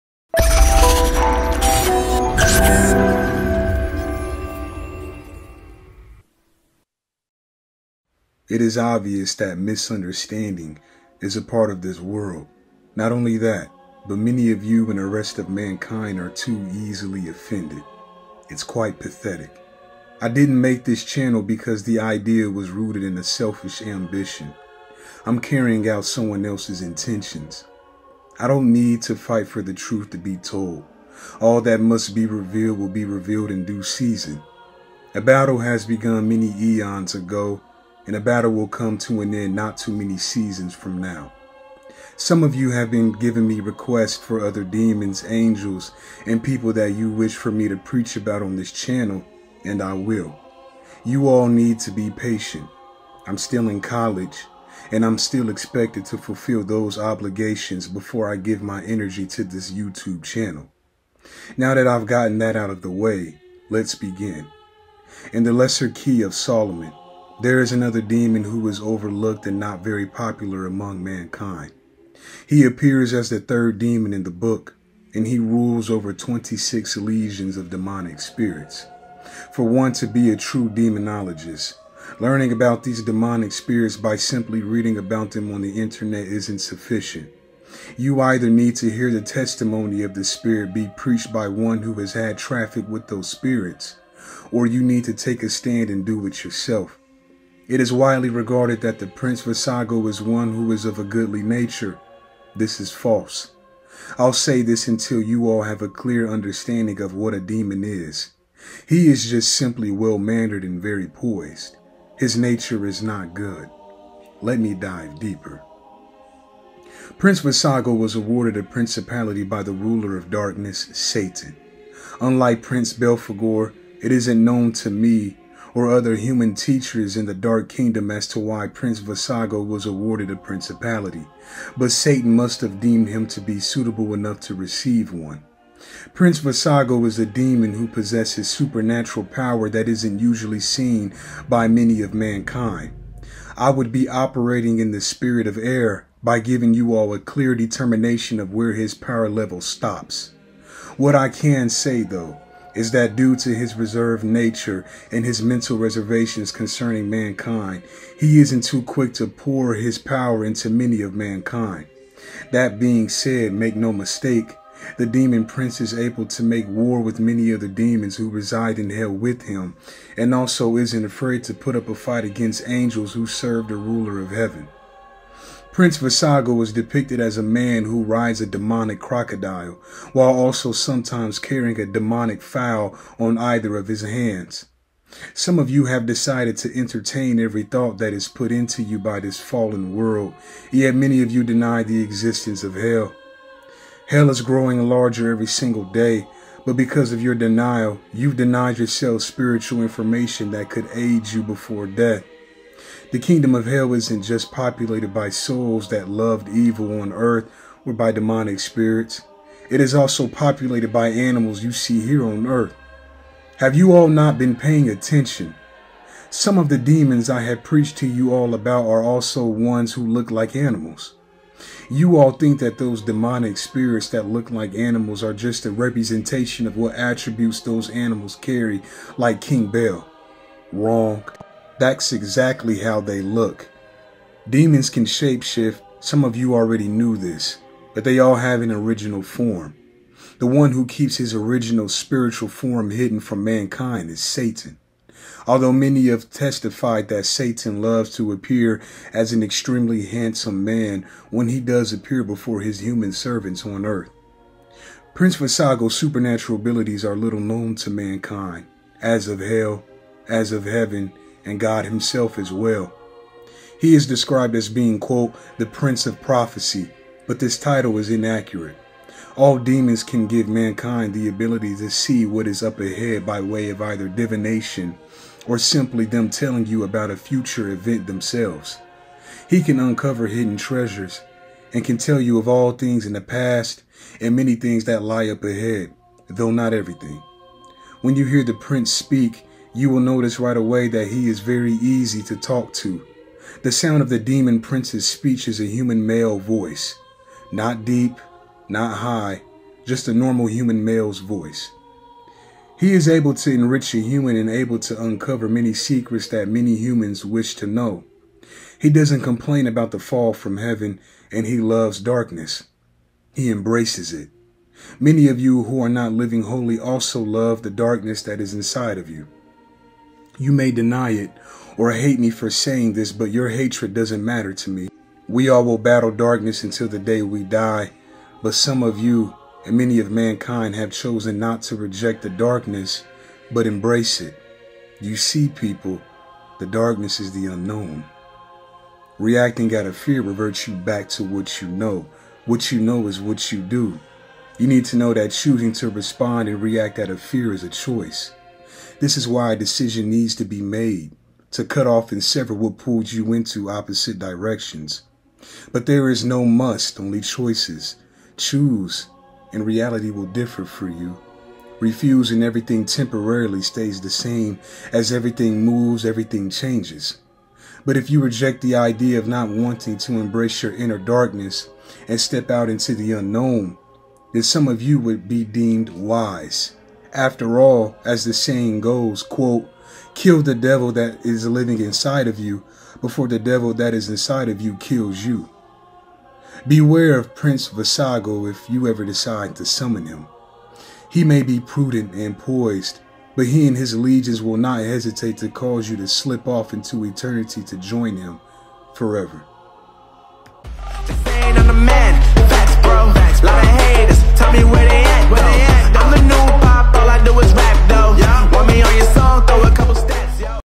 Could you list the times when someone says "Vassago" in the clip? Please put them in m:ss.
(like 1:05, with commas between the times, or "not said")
1:39, 1:57, 2:08, 2:16, 2:55, 4:15, 6:27.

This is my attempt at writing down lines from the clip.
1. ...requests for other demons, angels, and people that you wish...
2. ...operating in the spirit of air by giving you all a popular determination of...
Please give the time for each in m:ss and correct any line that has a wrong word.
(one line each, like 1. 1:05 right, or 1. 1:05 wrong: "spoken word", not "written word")
1. 0:43 right
2. 2:24 wrong: "clear", not "popular".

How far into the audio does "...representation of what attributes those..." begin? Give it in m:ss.
3:45.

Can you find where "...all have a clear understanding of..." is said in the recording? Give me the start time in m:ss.
1:45.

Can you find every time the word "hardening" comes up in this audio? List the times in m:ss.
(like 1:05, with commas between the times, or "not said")
not said.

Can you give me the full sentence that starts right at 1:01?
Now that I've gotten that out of the way, let's begin.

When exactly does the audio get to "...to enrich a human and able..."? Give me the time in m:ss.
5:03.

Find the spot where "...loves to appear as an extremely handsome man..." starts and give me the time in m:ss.
4:07.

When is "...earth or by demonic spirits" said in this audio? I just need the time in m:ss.
3:27.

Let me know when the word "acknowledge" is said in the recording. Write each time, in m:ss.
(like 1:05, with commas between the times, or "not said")
not said.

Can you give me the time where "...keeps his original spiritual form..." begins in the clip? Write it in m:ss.
4:00.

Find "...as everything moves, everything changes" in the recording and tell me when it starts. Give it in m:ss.
6:04.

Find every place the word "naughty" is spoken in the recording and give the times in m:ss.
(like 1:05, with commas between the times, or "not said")
not said.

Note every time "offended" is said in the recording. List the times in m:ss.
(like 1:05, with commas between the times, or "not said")
0:17.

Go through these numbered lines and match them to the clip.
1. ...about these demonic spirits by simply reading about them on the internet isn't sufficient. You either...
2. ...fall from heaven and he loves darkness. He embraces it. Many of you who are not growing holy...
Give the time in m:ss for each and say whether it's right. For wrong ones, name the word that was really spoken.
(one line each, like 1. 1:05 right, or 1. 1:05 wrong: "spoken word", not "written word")
1. 1:22 right
2. 5:09 wrong: "living", not "growing".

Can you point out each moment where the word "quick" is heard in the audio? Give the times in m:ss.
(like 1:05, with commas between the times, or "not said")
2:38.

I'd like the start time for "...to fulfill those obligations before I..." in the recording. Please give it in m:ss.
0:56.